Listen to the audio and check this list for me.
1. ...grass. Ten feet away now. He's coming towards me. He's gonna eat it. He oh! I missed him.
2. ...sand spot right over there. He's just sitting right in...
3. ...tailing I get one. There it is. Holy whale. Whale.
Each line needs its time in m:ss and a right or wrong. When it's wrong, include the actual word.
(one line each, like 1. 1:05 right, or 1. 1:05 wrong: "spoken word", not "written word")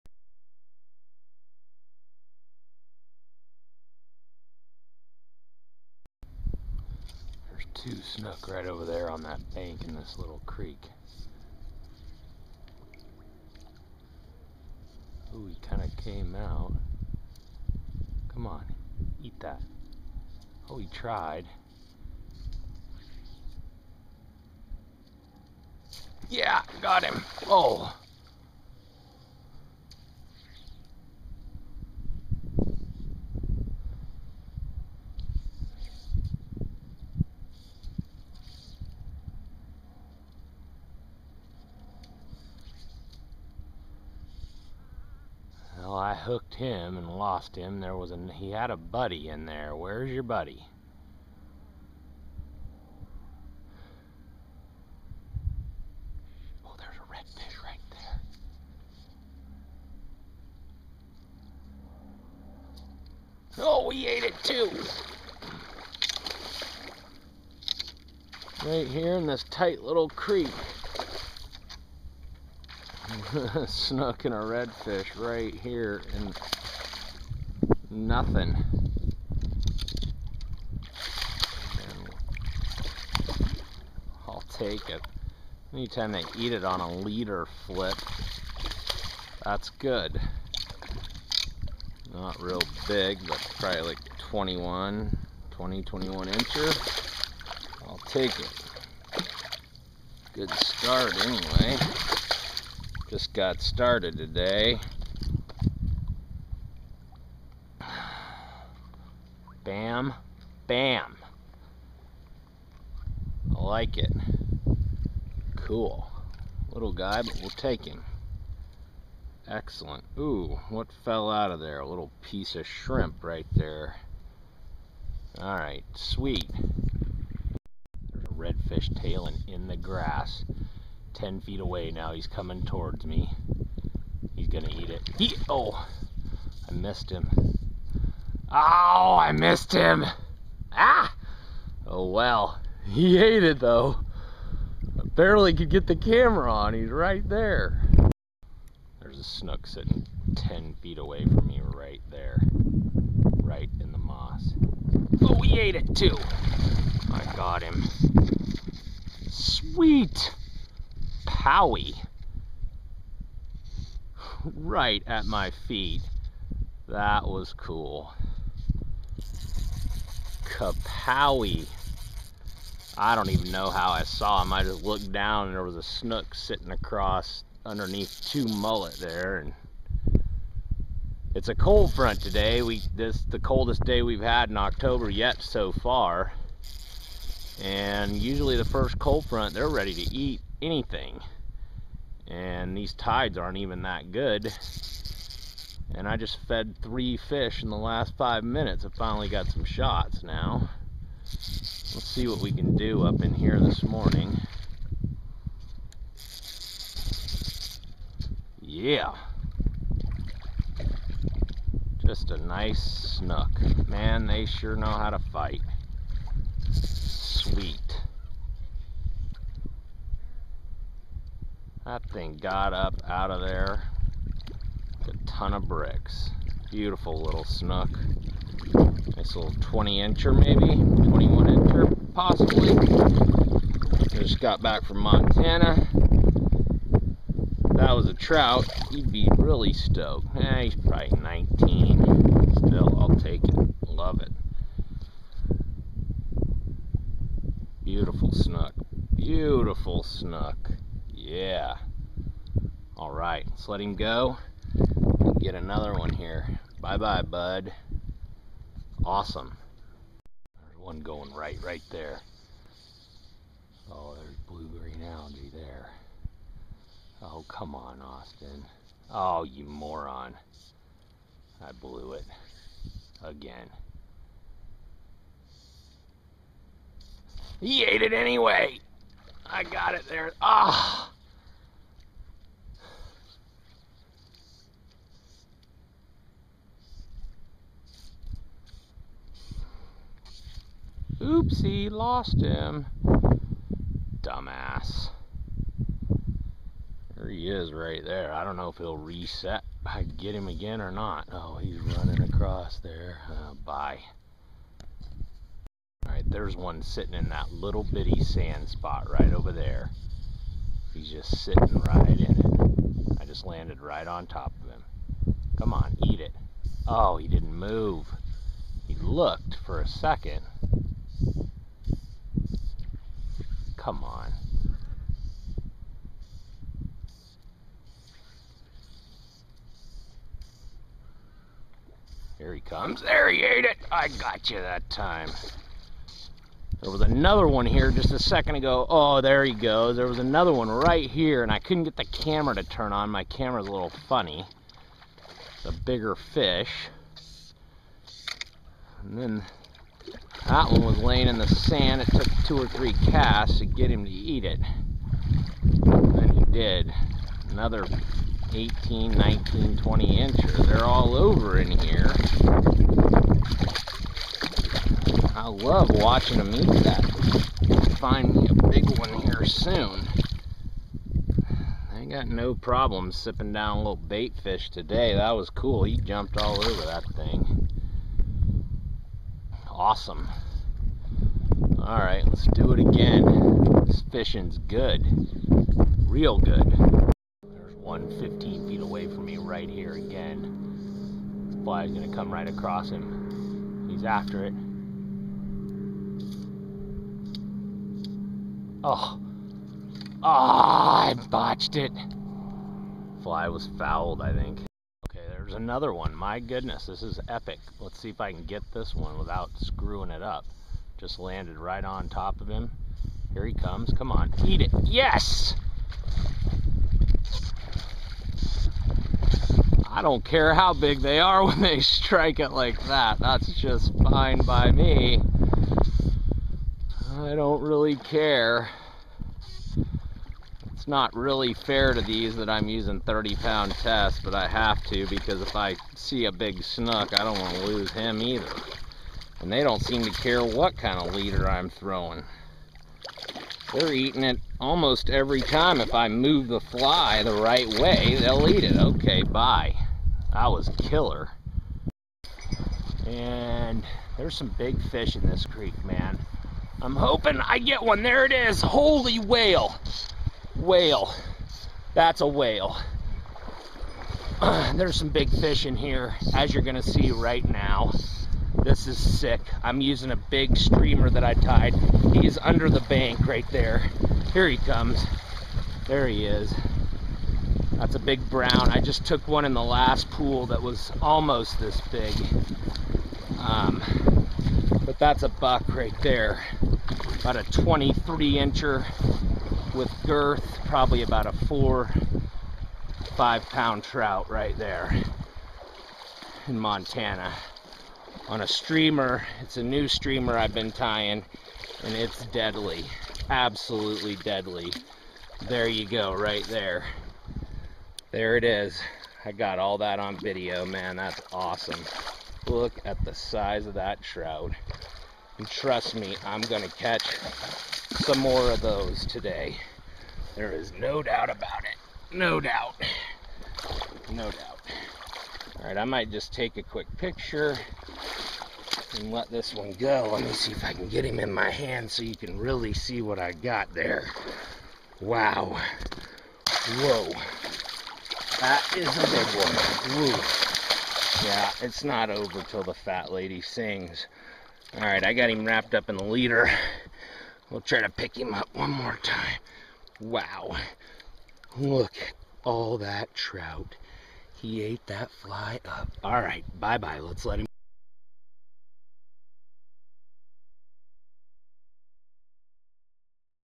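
1. 2:09 right
2. 5:08 right
3. 7:36 wrong: "hoping", not "tailing".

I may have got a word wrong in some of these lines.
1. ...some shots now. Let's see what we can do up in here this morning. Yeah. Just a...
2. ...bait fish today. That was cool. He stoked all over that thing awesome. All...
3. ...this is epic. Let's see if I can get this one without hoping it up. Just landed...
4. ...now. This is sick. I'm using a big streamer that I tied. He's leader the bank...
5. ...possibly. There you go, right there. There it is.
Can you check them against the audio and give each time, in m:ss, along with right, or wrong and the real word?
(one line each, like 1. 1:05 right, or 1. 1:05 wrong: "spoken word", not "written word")
1. 3:19 right
2. 6:13 wrong: "jumped", not "stoked"
3. 6:46 wrong: "screwing", not "hoping"
4. 7:47 wrong: "under", not "leader"
5. 8:24 wrong: "deadly", not "possibly".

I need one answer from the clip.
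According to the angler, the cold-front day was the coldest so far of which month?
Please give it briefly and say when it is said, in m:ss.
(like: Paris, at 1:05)
October, at 3:04.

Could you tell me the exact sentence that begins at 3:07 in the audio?
And usually the first cold front they're ready to eat anything.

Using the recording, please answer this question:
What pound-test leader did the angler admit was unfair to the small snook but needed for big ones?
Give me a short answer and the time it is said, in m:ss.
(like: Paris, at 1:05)
30 pound, at 7:12.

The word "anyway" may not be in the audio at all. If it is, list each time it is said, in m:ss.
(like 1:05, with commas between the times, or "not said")
1:41, 4:38.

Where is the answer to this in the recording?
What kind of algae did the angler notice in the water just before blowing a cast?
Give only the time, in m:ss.
4:24.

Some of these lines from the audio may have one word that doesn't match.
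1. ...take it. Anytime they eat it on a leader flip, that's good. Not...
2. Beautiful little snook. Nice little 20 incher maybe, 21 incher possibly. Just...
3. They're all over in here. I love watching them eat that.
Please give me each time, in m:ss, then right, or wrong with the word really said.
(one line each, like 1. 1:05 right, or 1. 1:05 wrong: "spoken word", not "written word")
1. 1:24 right
2. 3:46 right
3. 6:00 right.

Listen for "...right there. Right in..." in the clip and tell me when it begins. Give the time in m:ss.
2:31.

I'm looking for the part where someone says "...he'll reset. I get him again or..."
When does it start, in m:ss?
4:58.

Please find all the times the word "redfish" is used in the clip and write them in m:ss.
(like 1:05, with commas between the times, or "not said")
0:57, 1:14, 2:08.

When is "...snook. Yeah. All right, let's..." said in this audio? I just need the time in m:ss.
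4:10.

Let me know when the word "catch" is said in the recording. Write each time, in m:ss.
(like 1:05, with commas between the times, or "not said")
8:36.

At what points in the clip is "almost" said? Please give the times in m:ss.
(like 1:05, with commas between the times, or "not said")
7:24, 8:01.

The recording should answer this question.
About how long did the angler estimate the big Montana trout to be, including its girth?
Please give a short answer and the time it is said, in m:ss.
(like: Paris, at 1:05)
23 inches, at 8:07.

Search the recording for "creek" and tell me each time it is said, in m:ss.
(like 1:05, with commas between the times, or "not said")
0:10, 1:10, 7:35.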